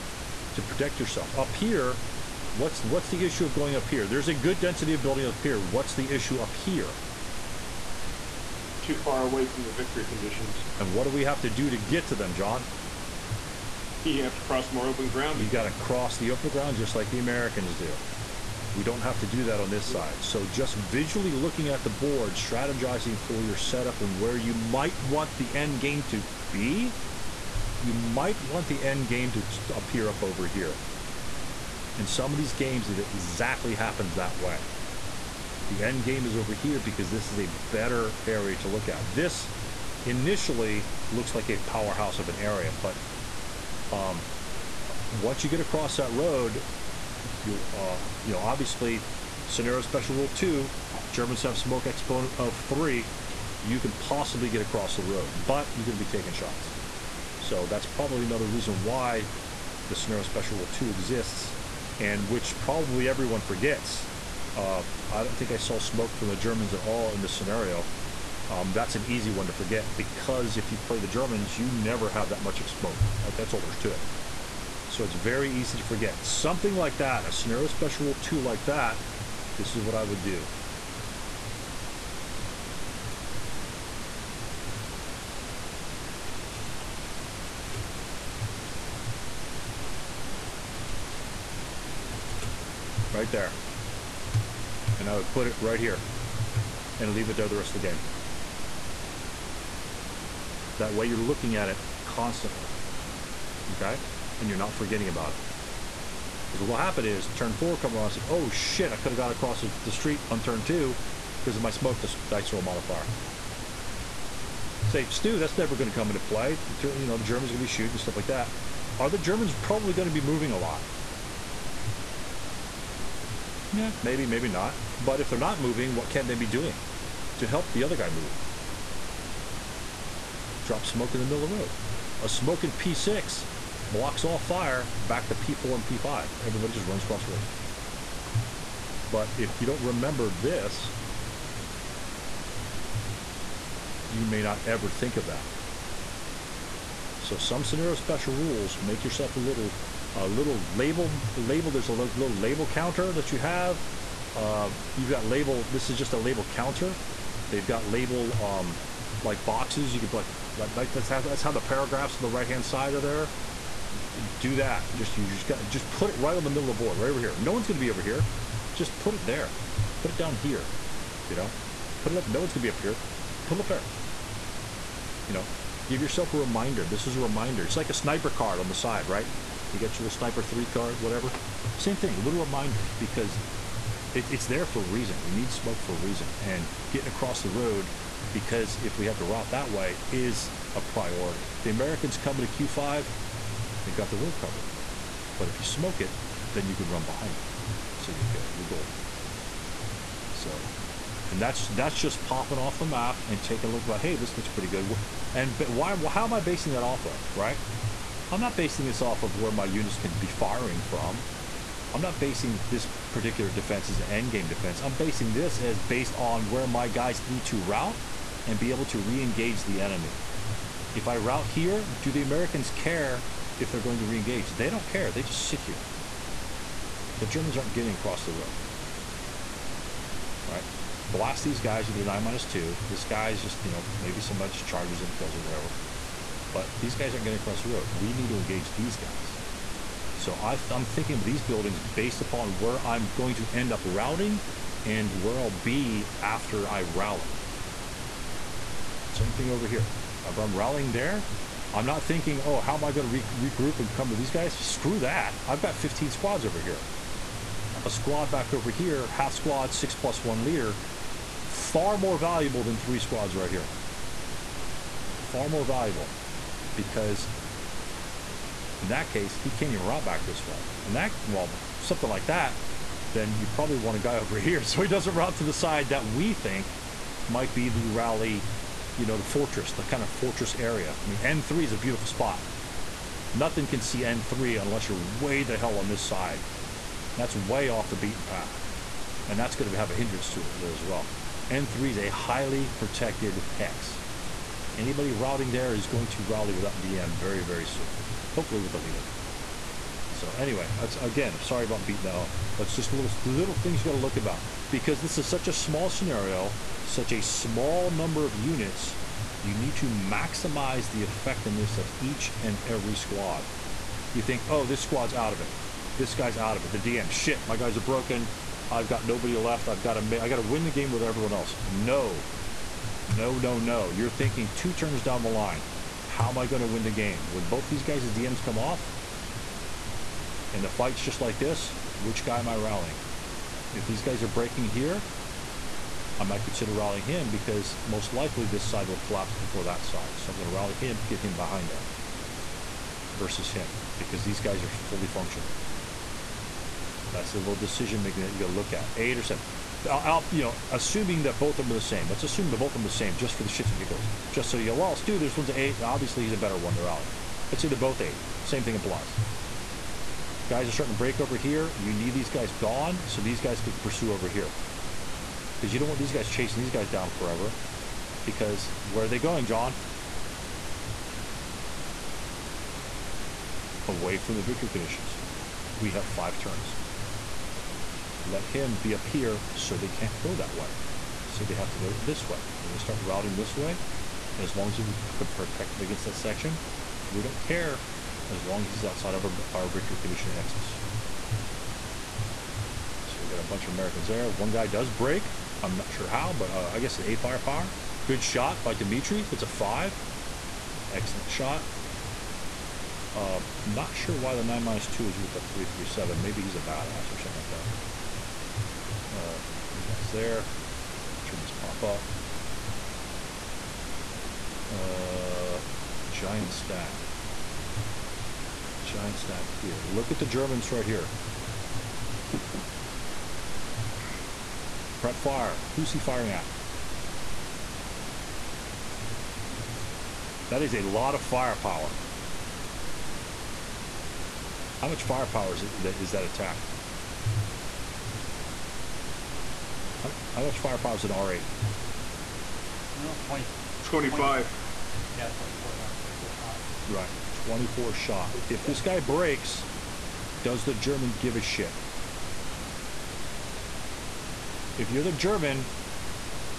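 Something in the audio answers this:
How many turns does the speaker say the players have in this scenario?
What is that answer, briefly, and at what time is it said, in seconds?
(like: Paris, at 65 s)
5, at 376 s.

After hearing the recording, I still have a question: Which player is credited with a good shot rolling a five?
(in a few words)
Dimitri.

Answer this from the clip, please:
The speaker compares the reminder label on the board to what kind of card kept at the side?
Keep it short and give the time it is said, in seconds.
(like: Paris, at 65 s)
Sniper card, at 177 s.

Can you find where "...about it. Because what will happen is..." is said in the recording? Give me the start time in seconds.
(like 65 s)
105 s.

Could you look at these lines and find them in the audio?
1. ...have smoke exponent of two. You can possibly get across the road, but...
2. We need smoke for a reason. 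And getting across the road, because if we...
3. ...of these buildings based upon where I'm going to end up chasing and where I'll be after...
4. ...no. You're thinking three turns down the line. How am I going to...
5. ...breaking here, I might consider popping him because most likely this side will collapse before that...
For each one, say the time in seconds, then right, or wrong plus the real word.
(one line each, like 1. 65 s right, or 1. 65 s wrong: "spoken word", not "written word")
1. 51 s wrong: "three", not "two"
2. 185 s right
3. 241 s wrong: "routing", not "chasing"
4. 323 s wrong: "two", not "three"
5. 334 s wrong: "rallying", not "popping".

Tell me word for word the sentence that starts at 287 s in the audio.
That's way off the beaten path.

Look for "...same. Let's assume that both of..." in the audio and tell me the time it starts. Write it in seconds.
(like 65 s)
351 s.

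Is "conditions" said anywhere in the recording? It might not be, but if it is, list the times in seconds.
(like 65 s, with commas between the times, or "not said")
10 s, 374 s, 389 s.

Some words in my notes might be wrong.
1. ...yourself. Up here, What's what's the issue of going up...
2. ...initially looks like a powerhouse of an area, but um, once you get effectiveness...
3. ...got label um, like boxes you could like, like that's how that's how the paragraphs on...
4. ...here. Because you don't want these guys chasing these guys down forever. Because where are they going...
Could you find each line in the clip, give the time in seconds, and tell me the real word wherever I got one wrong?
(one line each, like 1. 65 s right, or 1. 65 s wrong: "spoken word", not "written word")
1. 0 s right
2. 40 s wrong: "across", not "effectiveness"
3. 157 s right
4. 364 s right.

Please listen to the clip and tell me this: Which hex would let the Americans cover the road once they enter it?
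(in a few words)
Q5.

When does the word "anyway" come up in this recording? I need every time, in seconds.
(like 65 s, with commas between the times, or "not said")
300 s.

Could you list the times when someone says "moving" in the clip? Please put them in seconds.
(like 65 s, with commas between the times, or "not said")
120 s, 125 s.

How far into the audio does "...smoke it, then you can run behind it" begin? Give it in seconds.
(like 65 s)
195 s.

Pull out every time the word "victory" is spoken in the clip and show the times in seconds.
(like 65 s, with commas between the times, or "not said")
9 s, 374 s, 389 s.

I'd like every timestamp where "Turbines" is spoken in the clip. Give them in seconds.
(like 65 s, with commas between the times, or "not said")
411 s.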